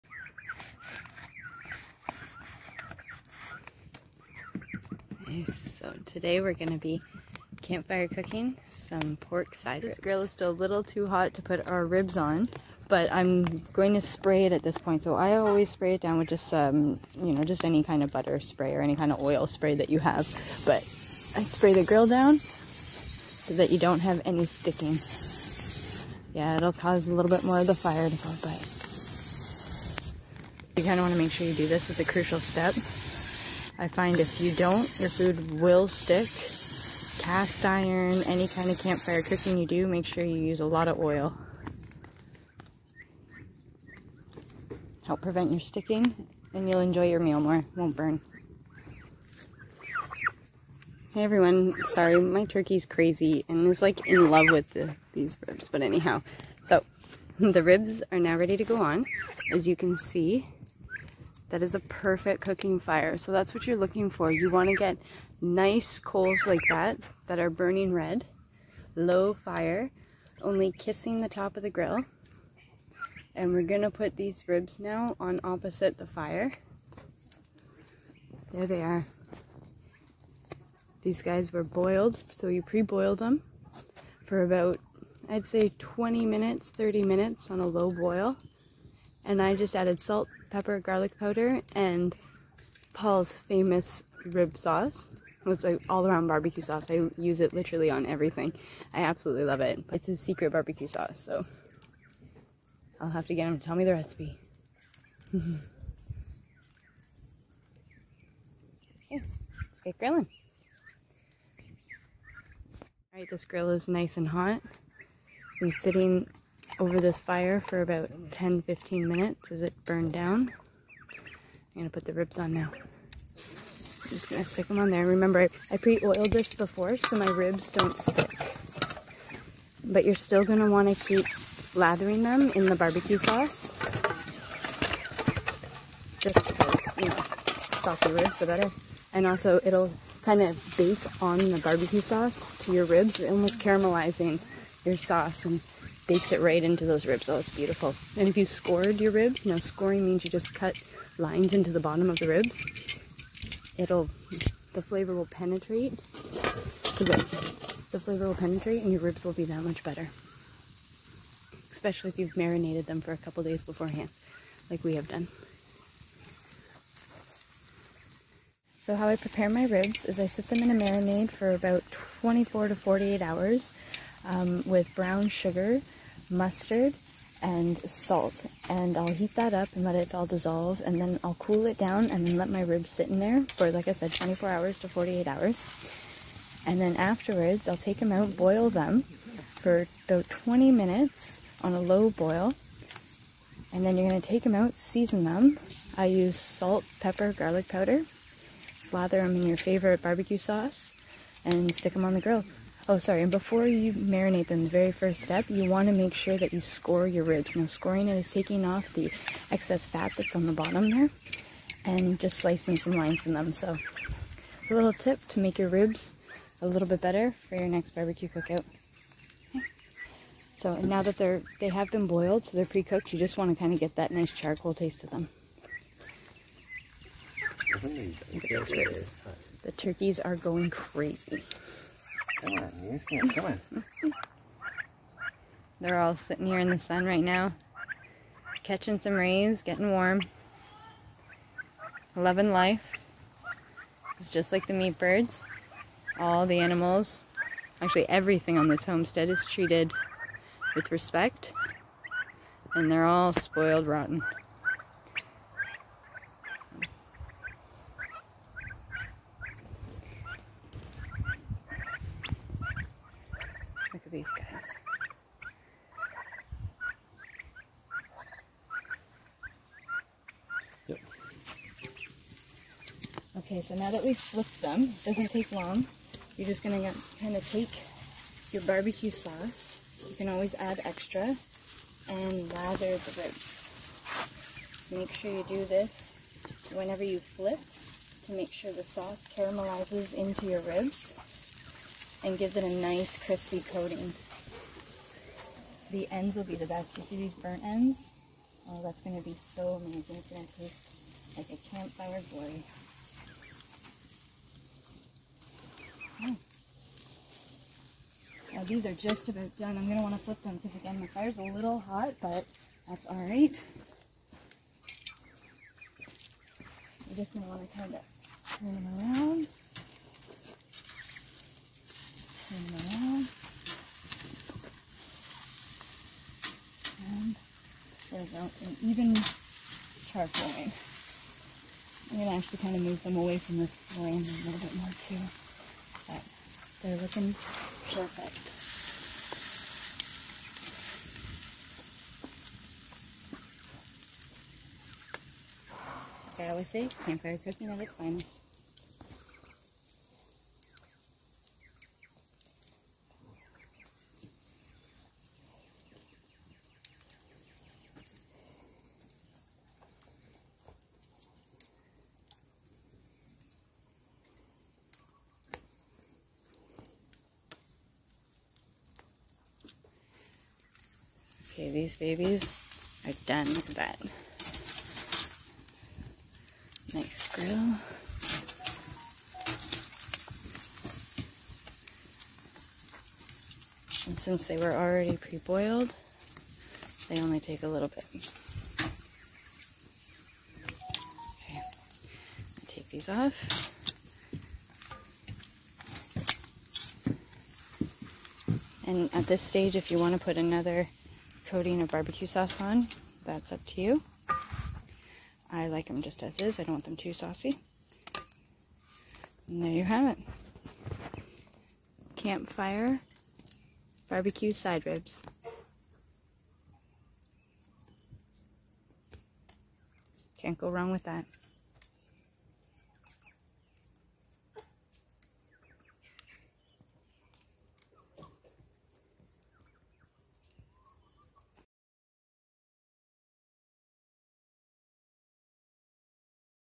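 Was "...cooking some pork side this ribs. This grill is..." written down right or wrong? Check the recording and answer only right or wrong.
right.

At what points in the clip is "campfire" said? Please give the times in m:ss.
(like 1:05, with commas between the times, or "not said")
0:07, 0:38, 5:01, 5:47, 6:52.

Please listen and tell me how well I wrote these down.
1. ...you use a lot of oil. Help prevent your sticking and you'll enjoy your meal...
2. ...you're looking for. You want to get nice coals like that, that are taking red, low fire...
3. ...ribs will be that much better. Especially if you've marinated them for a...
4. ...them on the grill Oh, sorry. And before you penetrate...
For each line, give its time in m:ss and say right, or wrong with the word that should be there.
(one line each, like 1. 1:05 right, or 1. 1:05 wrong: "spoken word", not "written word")
1. 0:40 right
2. 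1:03 wrong: "burning", not "taking"
3. 2:39 right
4. 3:21 wrong: "marinate", not "penetrate".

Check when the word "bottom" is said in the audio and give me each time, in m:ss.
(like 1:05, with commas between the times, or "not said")
2:31, 3:30.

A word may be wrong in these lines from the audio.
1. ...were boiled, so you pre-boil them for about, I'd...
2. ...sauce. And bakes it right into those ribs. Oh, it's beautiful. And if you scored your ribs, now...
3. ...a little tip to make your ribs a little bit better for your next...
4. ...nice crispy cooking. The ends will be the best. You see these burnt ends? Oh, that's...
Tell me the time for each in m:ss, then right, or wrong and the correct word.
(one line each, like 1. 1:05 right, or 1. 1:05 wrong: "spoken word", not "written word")
1. 1:21 right
2. 2:24 right
3. 3:34 right
4. 4:52 wrong: "coating", not "cooking".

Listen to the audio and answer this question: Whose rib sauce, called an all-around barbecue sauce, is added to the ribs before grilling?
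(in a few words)
Paul's.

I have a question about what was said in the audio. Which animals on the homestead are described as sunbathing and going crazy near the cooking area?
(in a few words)
turkeys.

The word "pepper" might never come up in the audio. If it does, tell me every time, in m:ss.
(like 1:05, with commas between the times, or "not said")
1:30, 3:17.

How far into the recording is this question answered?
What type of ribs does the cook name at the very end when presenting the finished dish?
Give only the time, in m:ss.
6:54.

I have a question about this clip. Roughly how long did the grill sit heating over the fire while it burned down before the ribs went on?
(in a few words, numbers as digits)
10-15 minutes.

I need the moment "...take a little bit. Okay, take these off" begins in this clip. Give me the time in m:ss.
6:27.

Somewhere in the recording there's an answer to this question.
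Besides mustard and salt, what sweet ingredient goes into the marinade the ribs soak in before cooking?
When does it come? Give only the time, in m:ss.
2:54.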